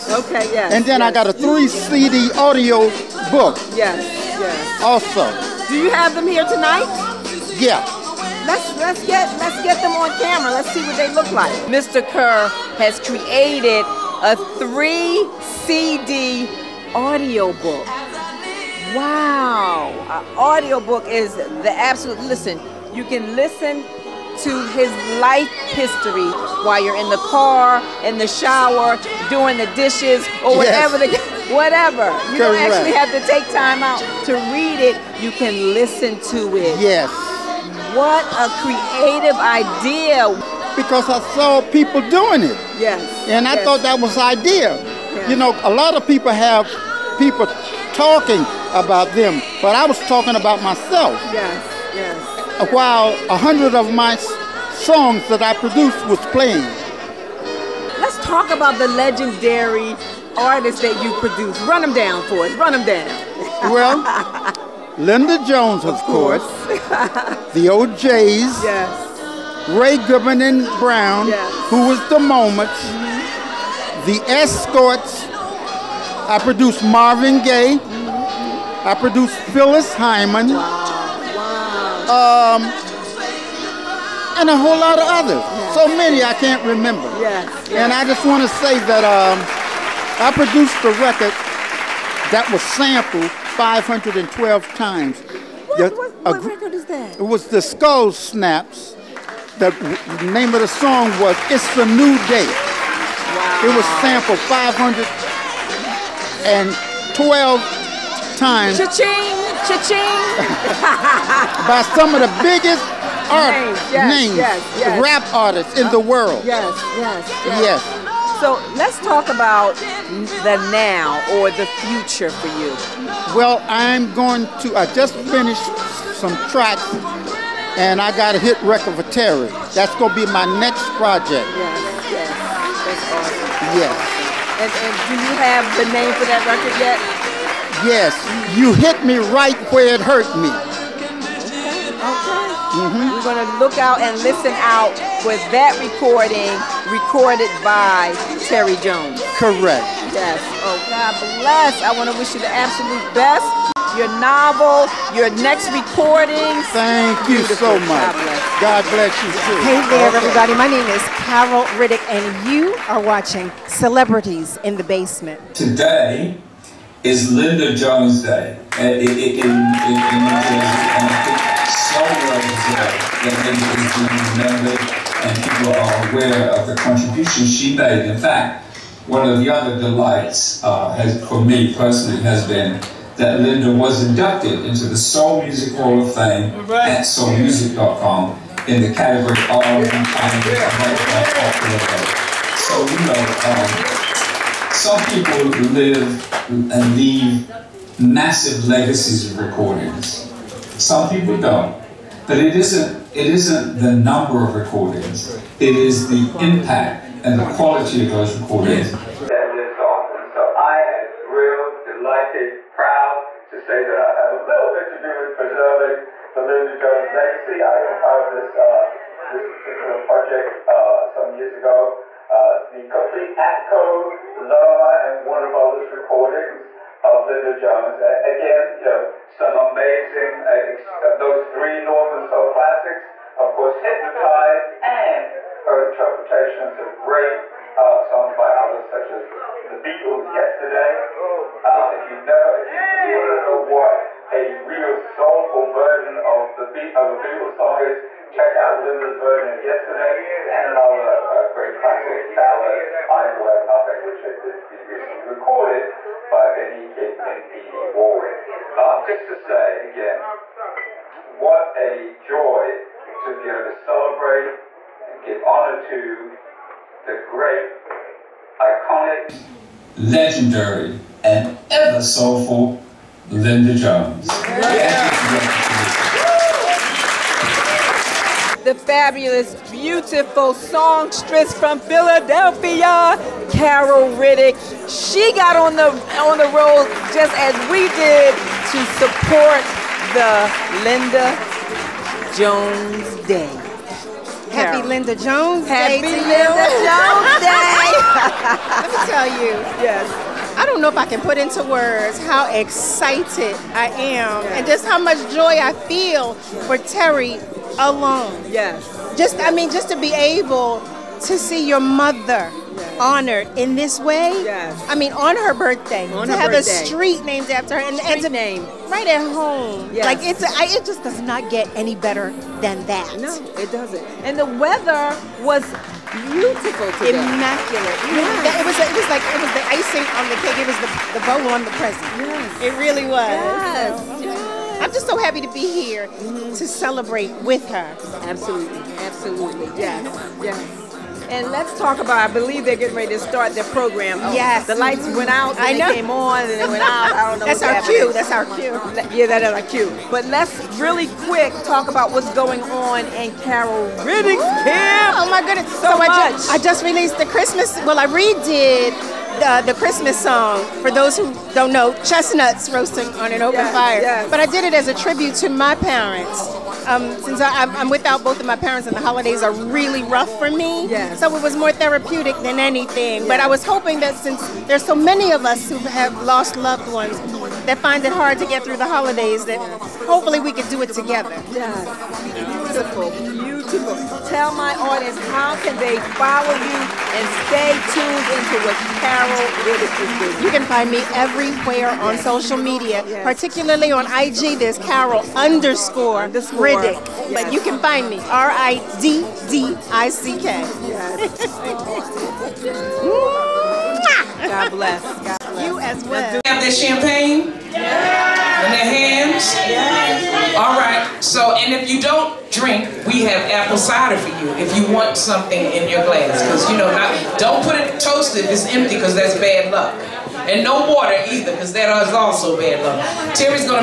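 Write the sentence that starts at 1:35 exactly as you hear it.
What, what, what record is that?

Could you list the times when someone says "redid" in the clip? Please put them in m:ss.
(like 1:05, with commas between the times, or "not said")
5:58.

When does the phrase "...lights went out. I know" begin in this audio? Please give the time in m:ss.
5:44.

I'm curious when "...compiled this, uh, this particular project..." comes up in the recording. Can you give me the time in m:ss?
3:37.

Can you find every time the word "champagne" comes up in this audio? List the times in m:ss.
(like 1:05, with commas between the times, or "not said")
6:46.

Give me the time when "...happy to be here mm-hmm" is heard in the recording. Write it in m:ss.
5:35.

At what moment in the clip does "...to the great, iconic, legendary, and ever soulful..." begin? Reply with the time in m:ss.
4:25.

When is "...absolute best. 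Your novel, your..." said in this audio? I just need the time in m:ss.
2:32.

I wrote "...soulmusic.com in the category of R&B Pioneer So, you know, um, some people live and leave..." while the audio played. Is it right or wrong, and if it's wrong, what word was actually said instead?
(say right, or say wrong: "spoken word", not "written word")
right.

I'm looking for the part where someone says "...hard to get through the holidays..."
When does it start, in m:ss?
6:18.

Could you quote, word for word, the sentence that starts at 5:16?
a street named after her, and, and to, name right at home.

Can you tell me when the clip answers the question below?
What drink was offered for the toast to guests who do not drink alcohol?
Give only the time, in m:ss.
6:53.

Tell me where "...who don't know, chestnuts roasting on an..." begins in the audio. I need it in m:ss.
6:01.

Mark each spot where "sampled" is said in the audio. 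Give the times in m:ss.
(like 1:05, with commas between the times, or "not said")
1:32, 1:44.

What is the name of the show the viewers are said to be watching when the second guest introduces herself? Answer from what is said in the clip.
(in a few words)
Celebrities in the Basement.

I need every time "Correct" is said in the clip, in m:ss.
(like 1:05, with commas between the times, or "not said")
0:32, 2:29.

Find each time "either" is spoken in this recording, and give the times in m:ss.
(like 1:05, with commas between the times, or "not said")
7:01.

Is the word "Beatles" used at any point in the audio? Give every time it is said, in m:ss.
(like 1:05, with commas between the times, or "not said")
3:59, 4:07.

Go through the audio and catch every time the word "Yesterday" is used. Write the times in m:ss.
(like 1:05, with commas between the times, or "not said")
4:00, 4:09.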